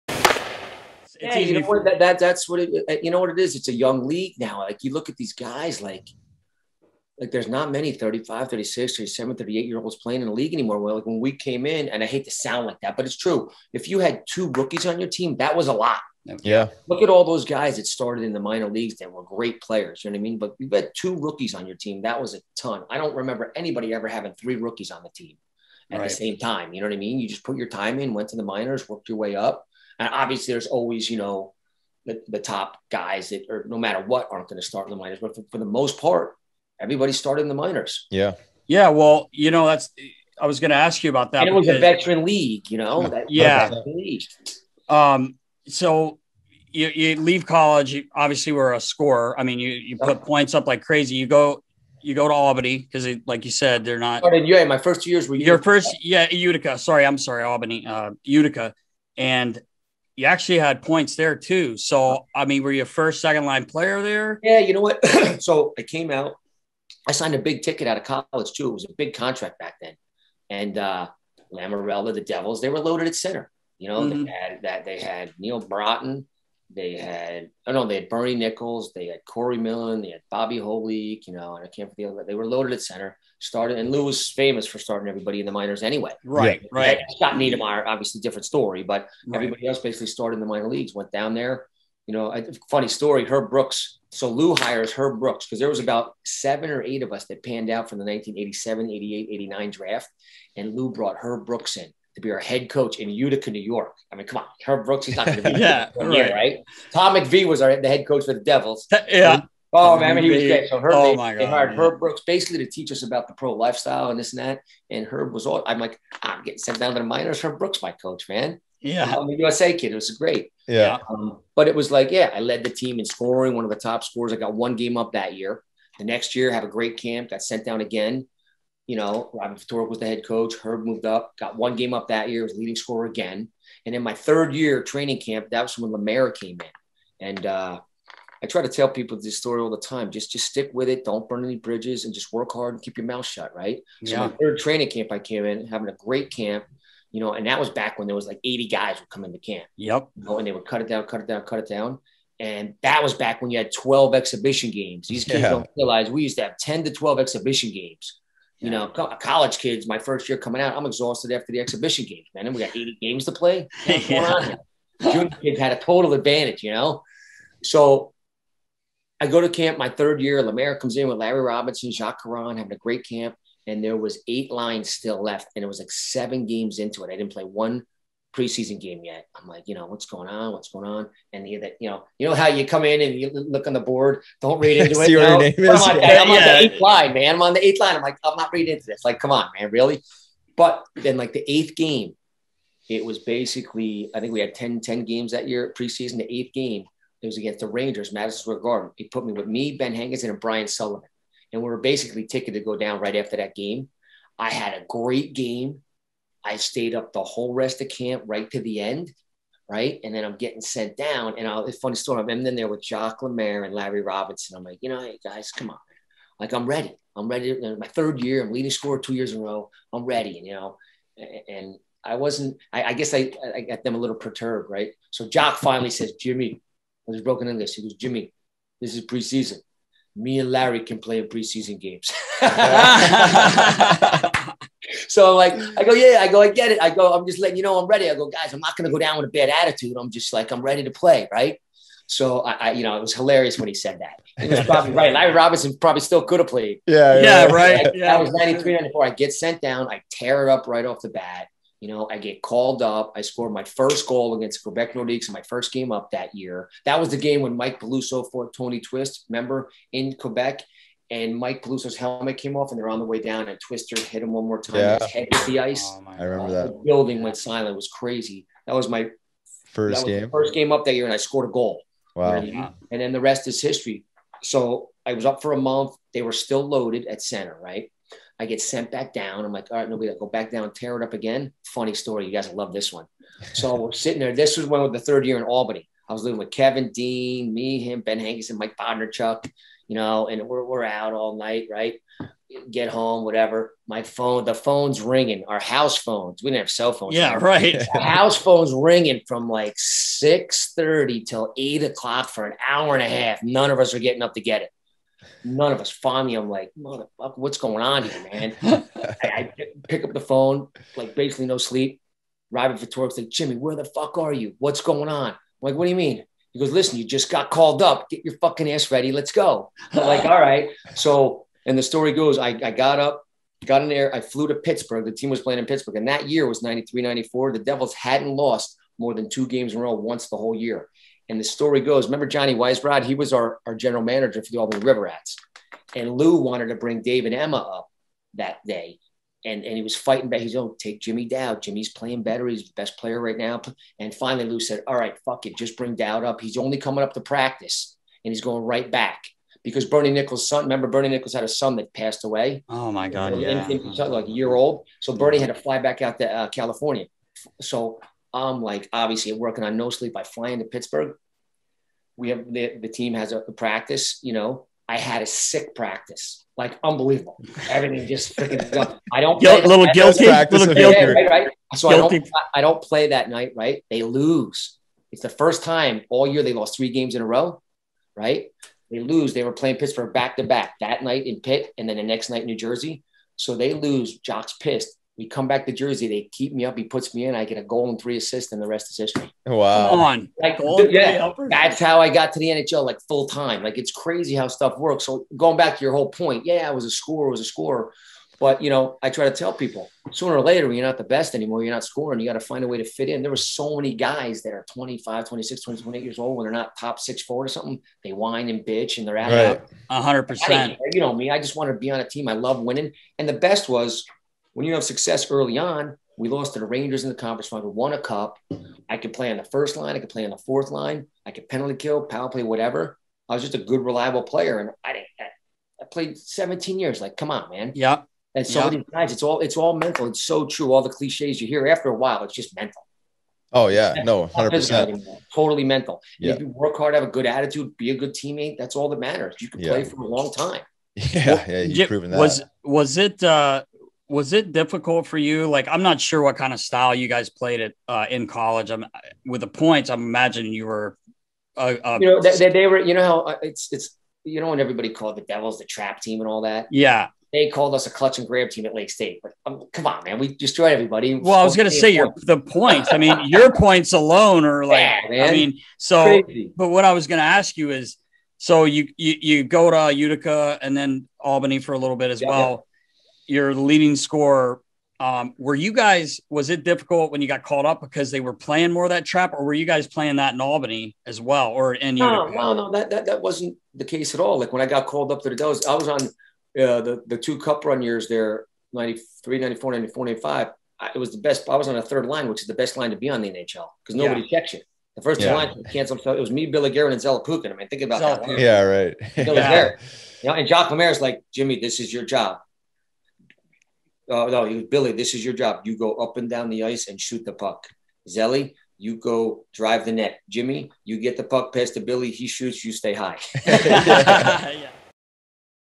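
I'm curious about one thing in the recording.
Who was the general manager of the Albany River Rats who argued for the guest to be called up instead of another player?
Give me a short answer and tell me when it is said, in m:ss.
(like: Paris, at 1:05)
Johnny Weisbrod, at 5:32.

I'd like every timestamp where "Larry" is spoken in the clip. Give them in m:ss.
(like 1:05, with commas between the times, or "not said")
2:51, 3:33, 3:50, 4:05.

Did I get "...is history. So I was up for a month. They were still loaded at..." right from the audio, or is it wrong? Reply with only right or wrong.
right.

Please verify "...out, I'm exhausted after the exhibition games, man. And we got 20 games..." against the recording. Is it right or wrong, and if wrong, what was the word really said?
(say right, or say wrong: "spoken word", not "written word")
wrong: "80", not "20".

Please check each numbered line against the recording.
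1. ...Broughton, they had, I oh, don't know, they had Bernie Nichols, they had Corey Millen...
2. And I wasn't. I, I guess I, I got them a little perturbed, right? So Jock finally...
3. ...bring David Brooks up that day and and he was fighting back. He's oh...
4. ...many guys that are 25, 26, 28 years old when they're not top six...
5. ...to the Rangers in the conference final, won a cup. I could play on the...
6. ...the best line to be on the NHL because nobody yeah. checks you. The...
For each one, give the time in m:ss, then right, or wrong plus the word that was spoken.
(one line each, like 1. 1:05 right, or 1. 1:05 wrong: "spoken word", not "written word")
1. 1:15 right
2. 3:41 right
3. 5:36 wrong: "Emma", not "Brooks"
4. 6:43 right
5. 6:56 right
6. 8:12 right.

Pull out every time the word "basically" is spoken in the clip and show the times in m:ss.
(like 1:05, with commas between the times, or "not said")
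1:29, 1:52, 3:13, 3:21, 5:11.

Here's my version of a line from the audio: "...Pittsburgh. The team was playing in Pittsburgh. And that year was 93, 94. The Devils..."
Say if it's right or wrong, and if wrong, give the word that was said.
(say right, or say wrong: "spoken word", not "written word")
right.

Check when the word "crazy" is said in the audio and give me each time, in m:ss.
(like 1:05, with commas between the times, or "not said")
0:50, 4:27, 6:33, 7:46.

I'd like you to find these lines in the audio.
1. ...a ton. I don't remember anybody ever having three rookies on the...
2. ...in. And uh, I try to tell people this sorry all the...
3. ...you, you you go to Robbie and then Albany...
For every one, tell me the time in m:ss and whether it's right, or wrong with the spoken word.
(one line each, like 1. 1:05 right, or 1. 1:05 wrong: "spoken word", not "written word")
1. 0:22 right
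2. 2:16 wrong: "story", not "sorry"
3. 7:48 wrong: "Utica", not "Robbie".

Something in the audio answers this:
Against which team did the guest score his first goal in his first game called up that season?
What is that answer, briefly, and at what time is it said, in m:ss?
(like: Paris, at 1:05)
Quebec Nordiques, at 4:14.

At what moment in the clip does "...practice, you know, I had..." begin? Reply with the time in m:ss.
6:03.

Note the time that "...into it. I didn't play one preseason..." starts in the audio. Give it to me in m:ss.
2:56.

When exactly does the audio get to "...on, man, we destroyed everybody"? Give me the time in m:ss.
7:39.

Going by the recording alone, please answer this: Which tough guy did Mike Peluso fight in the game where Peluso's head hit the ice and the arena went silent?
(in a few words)
Tony Twist.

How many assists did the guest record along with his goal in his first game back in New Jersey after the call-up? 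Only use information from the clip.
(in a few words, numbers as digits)
3.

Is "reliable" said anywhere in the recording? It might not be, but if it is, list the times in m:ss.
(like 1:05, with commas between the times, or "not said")
7:03.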